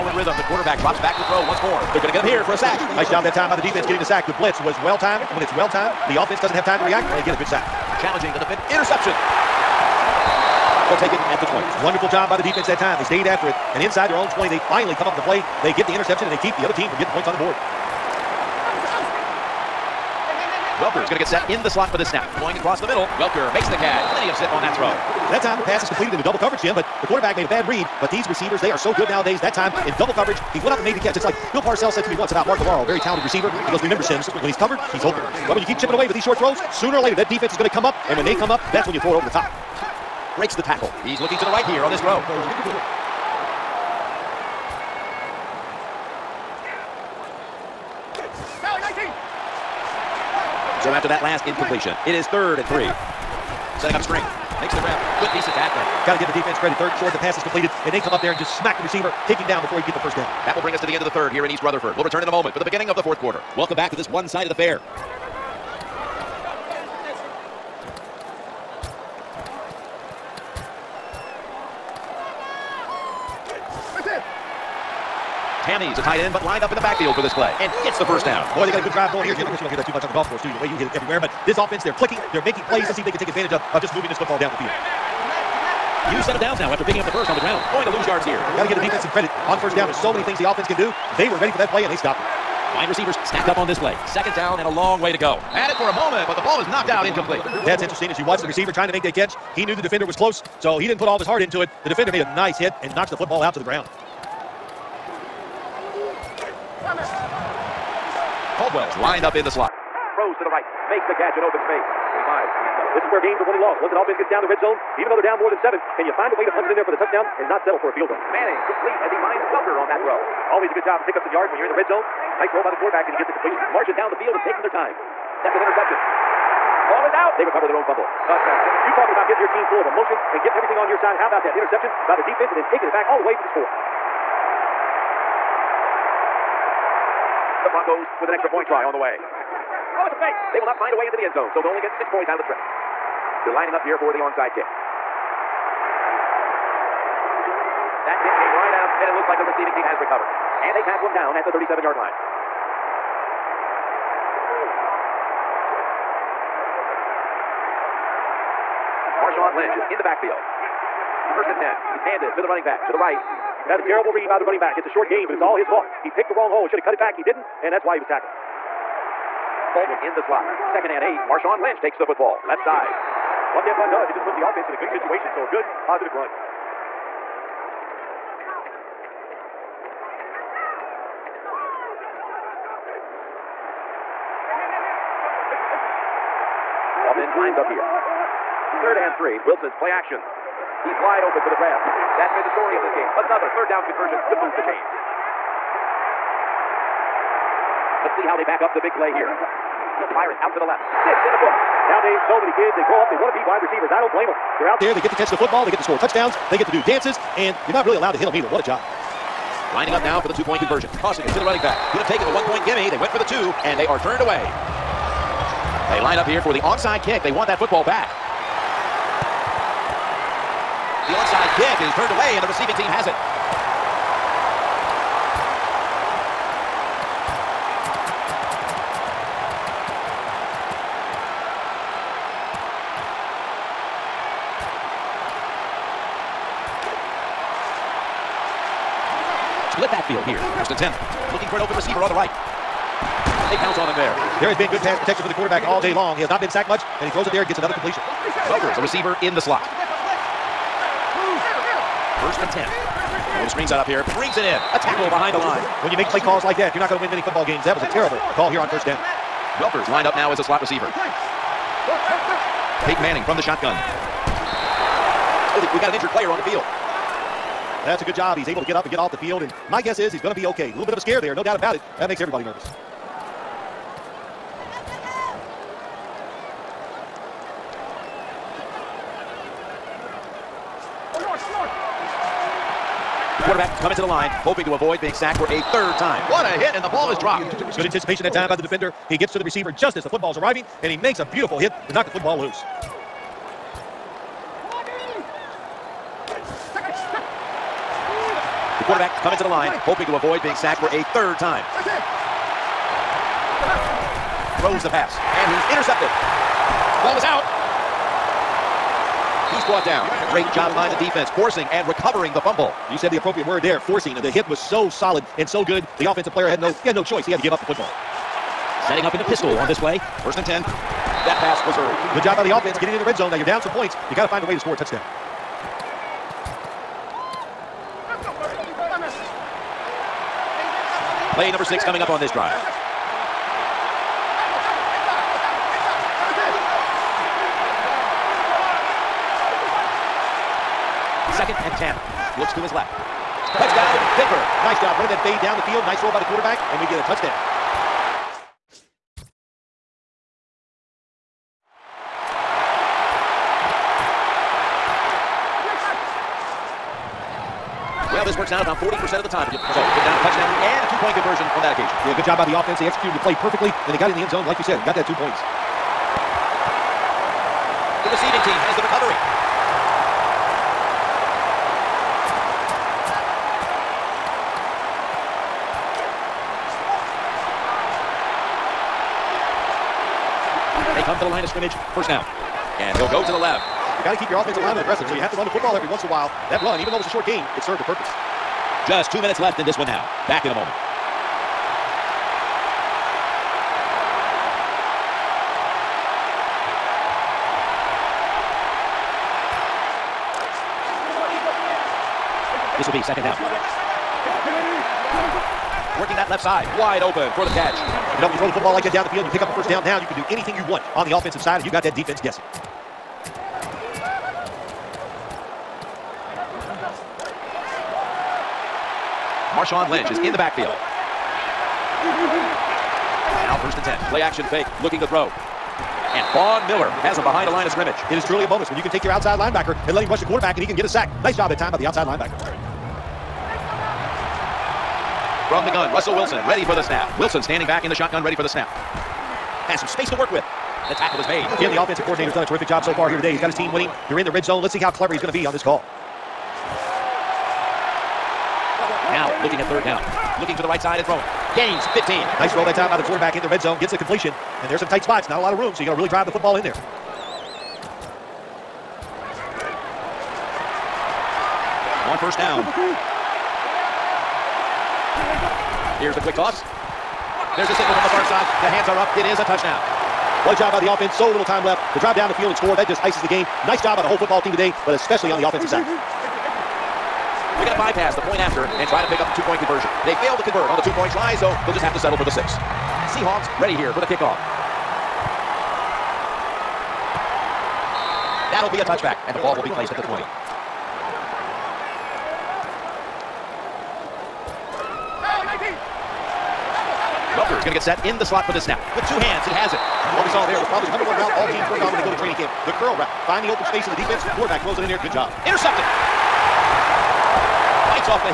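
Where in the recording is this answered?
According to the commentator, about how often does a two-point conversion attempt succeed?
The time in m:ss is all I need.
5:58.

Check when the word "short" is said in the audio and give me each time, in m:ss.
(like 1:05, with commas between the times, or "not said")
0:36, 0:57, 2:44, 6:27.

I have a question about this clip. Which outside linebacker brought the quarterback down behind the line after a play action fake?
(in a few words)
Von Miller.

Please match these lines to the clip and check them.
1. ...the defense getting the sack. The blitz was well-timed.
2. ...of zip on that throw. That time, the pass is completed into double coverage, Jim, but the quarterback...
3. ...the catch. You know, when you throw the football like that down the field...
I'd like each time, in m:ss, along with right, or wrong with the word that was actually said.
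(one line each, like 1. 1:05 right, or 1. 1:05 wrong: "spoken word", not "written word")
1. 0:03 right
2. 0:24 right
3. 6:47 right.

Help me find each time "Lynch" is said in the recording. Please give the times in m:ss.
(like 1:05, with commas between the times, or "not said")
2:39, 2:51, 6:59.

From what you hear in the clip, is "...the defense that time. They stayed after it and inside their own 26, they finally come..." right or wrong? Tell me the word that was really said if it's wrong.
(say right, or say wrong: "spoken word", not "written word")
wrong: "20", not "26".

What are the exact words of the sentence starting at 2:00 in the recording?
Always a good job to pick up some yards when you're in the red zone.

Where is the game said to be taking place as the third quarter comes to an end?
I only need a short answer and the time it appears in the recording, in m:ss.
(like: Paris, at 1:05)
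East Rutherford, at 1:01.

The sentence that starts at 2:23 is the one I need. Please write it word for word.
They're lining up here for the onside kick.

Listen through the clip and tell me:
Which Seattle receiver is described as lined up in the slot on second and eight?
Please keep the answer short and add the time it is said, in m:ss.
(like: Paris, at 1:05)
Baldwin, at 2:49.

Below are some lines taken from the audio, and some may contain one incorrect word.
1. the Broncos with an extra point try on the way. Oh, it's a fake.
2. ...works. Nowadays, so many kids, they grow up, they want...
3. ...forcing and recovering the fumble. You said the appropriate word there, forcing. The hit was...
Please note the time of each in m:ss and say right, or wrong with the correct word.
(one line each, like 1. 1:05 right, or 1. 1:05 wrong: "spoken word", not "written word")
1. 2:17 right
2. 3:21 wrong: "books", not "works"
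3. 5:11 right.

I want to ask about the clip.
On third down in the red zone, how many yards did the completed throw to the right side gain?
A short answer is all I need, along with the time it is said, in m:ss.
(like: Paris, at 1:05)
15, at 7:31.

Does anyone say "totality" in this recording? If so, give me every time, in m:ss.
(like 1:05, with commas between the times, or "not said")
not said.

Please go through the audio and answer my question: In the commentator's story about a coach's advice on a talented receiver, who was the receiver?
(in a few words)
Mark Bavaro.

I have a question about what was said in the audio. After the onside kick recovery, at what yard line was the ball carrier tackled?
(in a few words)
37-yard line.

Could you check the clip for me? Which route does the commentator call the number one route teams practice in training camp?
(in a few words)
the curl route.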